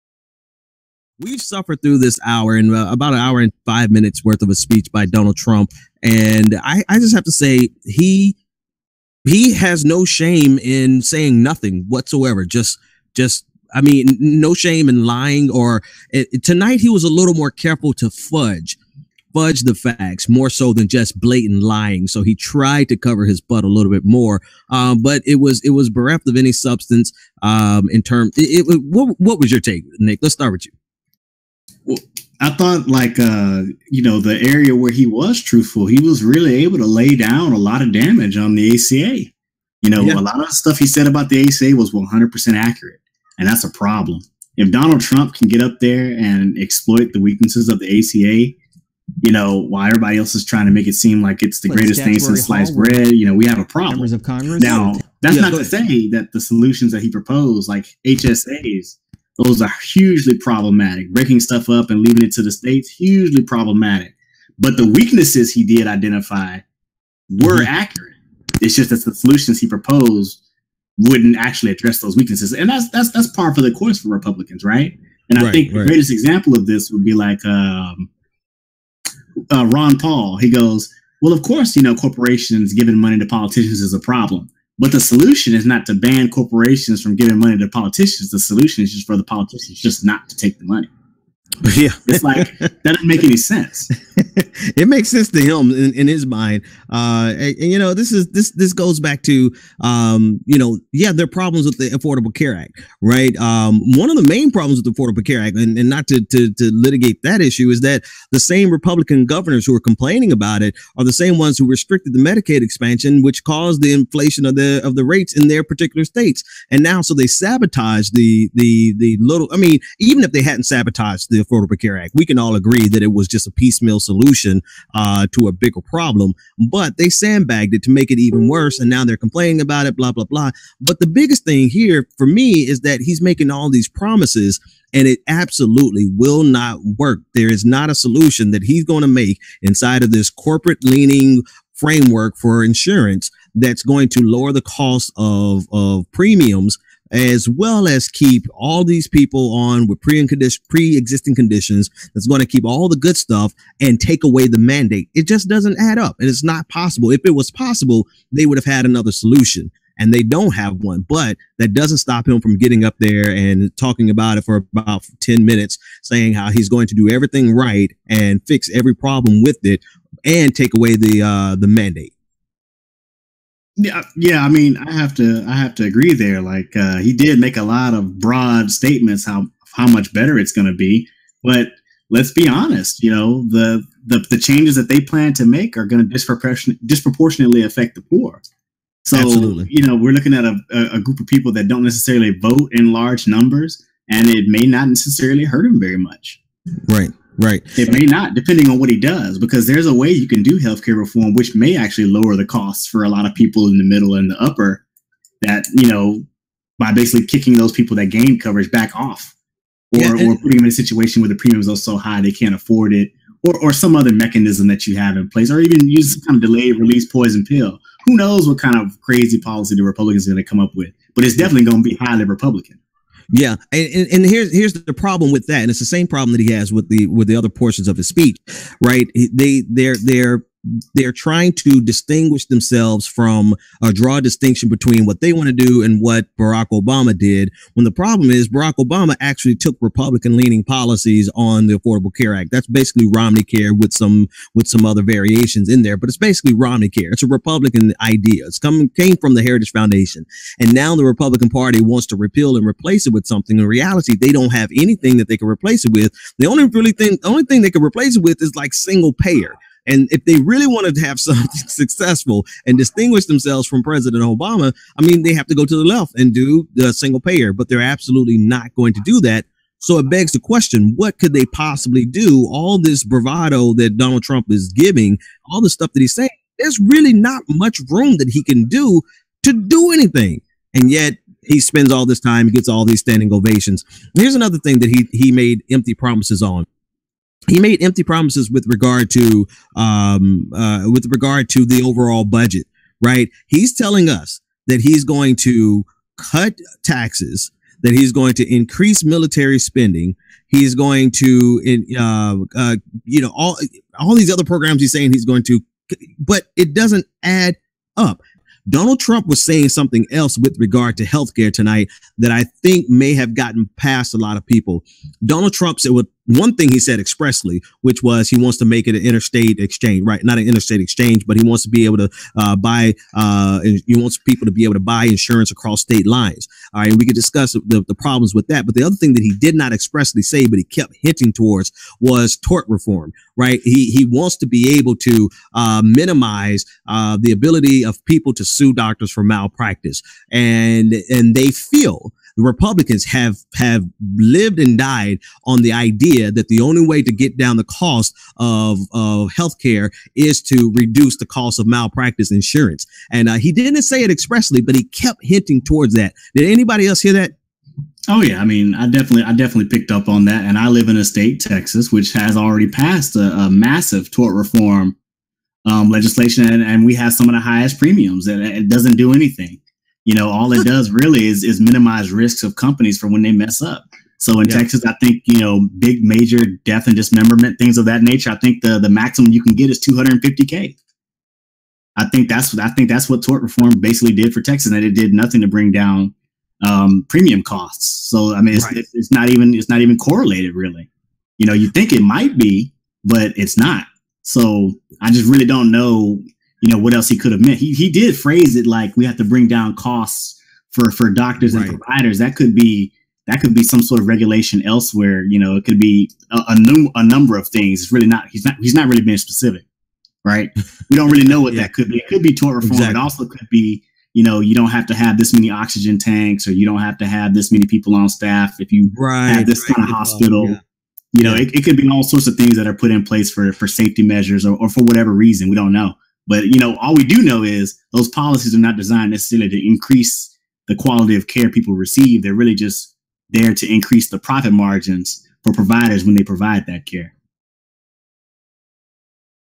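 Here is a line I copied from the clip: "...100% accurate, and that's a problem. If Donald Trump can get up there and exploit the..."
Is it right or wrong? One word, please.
right.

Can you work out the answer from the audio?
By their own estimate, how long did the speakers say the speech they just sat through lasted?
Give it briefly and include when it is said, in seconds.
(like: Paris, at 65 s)
an hour and five minutes, at 2 s.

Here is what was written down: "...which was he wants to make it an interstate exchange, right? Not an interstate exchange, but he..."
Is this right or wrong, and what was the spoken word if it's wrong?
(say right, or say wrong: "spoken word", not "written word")
right.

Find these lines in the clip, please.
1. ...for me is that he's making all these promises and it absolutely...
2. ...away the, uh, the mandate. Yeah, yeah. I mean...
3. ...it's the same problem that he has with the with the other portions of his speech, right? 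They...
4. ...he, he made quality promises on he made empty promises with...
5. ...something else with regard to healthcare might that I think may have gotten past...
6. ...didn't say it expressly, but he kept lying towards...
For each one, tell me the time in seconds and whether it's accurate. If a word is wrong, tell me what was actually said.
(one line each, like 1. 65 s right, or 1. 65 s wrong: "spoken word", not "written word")
1. 132 s right
2. 170 s right
3. 225 s right
4. 284 s wrong: "empty", not "quality"
5. 309 s wrong: "tonight", not "might"
6. 353 s wrong: "hinting", not "lying".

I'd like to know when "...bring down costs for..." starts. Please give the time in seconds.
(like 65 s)
399 s.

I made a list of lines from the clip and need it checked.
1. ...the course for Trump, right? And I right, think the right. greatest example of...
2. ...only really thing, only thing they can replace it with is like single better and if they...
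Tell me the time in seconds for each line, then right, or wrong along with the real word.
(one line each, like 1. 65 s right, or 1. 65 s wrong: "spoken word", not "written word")
1. 73 s wrong: "Republicans", not "Trump"
2. 256 s wrong: "payer", not "better".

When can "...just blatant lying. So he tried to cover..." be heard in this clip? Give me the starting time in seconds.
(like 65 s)
20 s.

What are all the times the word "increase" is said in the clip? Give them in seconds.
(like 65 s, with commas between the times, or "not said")
298 s, 429 s, 433 s.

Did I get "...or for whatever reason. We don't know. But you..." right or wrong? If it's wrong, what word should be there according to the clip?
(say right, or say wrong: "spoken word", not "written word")
right.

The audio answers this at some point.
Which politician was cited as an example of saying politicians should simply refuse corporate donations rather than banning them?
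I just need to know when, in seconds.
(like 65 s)
79 s.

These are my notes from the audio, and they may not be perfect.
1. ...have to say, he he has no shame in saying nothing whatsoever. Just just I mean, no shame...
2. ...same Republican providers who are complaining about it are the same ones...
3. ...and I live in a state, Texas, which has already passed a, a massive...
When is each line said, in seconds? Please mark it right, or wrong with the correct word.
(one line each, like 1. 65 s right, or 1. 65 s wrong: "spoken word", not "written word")
1. 7 s right
2. 108 s wrong: "governors", not "providers"
3. 360 s right.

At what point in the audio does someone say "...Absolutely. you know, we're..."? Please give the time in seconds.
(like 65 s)
189 s.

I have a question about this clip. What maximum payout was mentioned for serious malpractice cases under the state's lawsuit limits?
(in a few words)
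250k.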